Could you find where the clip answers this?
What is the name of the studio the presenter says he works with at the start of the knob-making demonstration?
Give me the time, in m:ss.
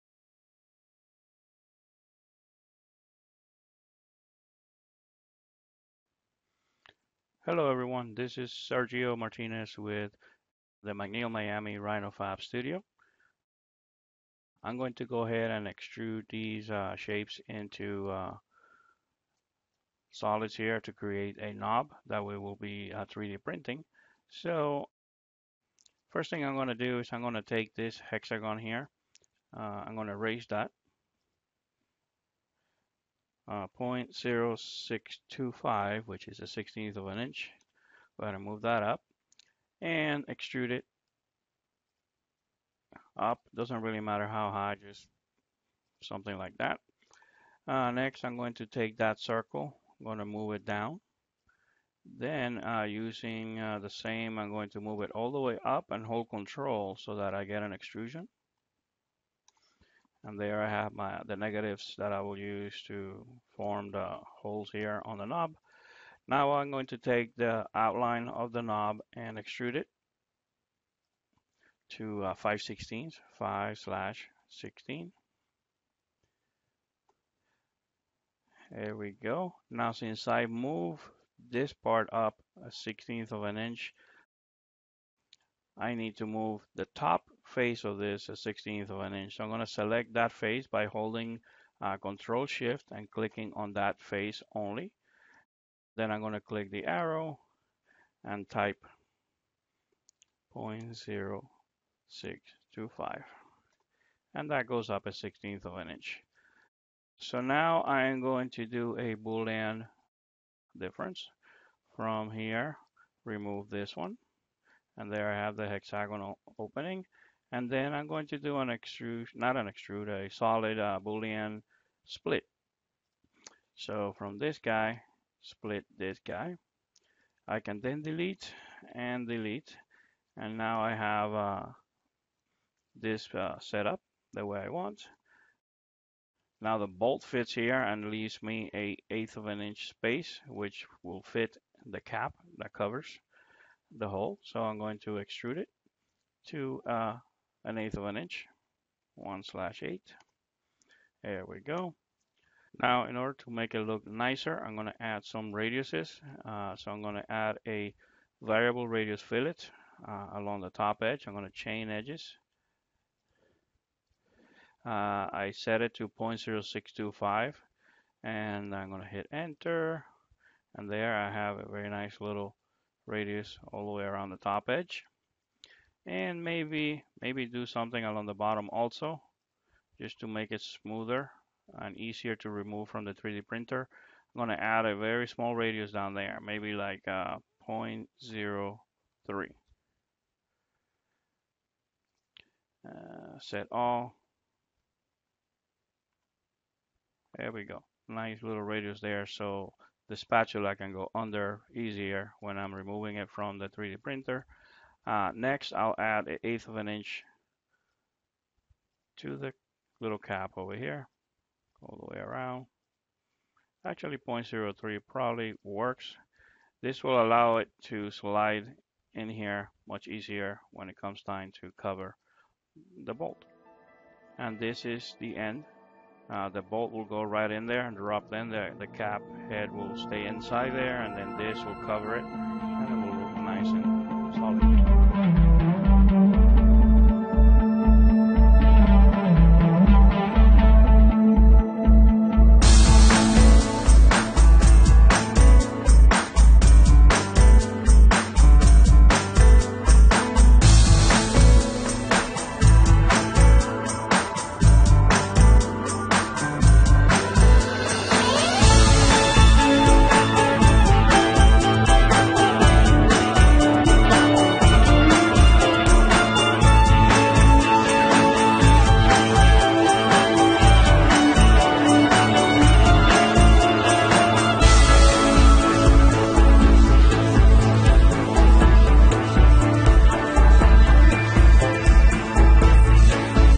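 0:10.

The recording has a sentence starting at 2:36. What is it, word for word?
Uh, so I'm going to add a variable radius fillet uh, along the top edge.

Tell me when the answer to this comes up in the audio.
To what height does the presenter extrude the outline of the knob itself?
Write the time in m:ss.
1:13.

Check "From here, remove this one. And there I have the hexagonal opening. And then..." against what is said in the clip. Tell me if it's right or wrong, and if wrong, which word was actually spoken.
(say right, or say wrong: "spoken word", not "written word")
right.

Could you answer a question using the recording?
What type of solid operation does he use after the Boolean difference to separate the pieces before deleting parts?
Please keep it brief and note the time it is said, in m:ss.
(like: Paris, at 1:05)
Boolean split, at 2:01.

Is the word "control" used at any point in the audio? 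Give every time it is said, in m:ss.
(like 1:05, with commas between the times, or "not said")
0:56, 1:31.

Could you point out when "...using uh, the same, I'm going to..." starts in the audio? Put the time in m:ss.
0:52.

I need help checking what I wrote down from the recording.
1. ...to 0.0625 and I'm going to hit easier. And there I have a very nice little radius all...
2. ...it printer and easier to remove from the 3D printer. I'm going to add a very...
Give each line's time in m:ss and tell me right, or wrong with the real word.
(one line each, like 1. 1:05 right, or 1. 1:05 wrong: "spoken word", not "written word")
1. 2:45 wrong: "enter", not "easier"
2. 3:00 wrong: "smoother", not "printer".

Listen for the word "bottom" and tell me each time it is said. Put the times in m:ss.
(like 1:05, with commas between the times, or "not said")
2:58.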